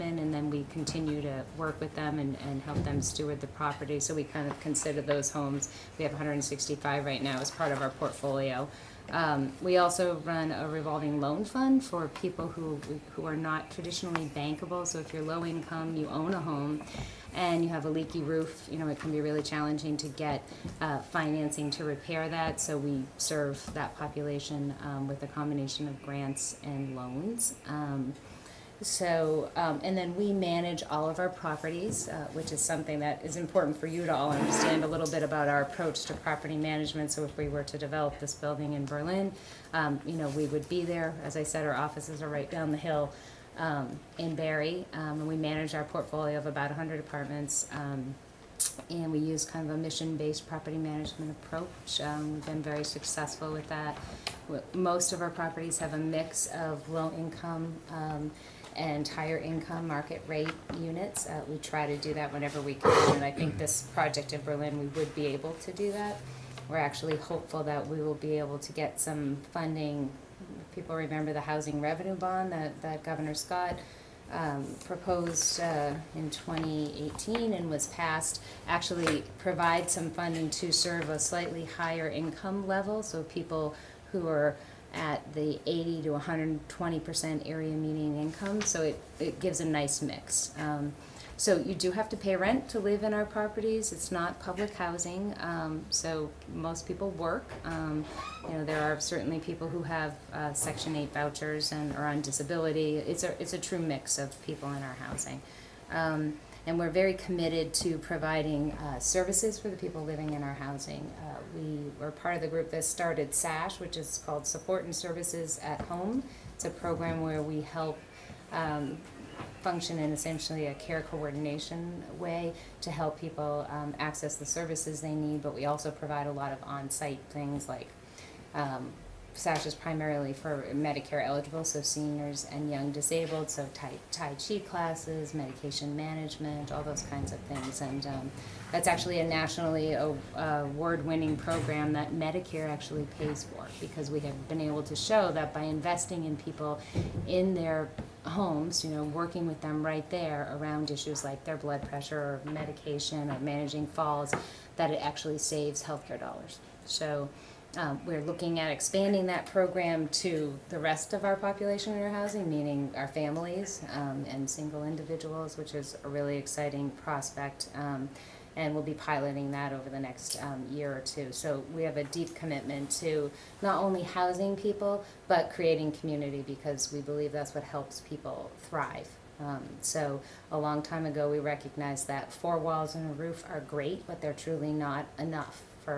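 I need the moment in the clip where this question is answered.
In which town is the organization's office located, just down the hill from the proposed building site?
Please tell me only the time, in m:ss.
0:44.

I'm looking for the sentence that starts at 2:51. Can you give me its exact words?
So we have a deep commitment to not only housing people, but creating community because we believe that's what helps people thrive.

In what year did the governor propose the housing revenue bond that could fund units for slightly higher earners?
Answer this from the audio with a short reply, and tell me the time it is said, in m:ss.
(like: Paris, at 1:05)
2018, at 1:16.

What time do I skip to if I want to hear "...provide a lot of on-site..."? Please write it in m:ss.
2:05.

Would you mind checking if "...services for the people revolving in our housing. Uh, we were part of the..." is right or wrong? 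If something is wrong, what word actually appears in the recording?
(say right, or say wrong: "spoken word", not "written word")
wrong: "living", not "revolving".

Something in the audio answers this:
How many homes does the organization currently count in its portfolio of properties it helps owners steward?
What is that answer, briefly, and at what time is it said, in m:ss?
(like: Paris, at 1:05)
165, at 0:06.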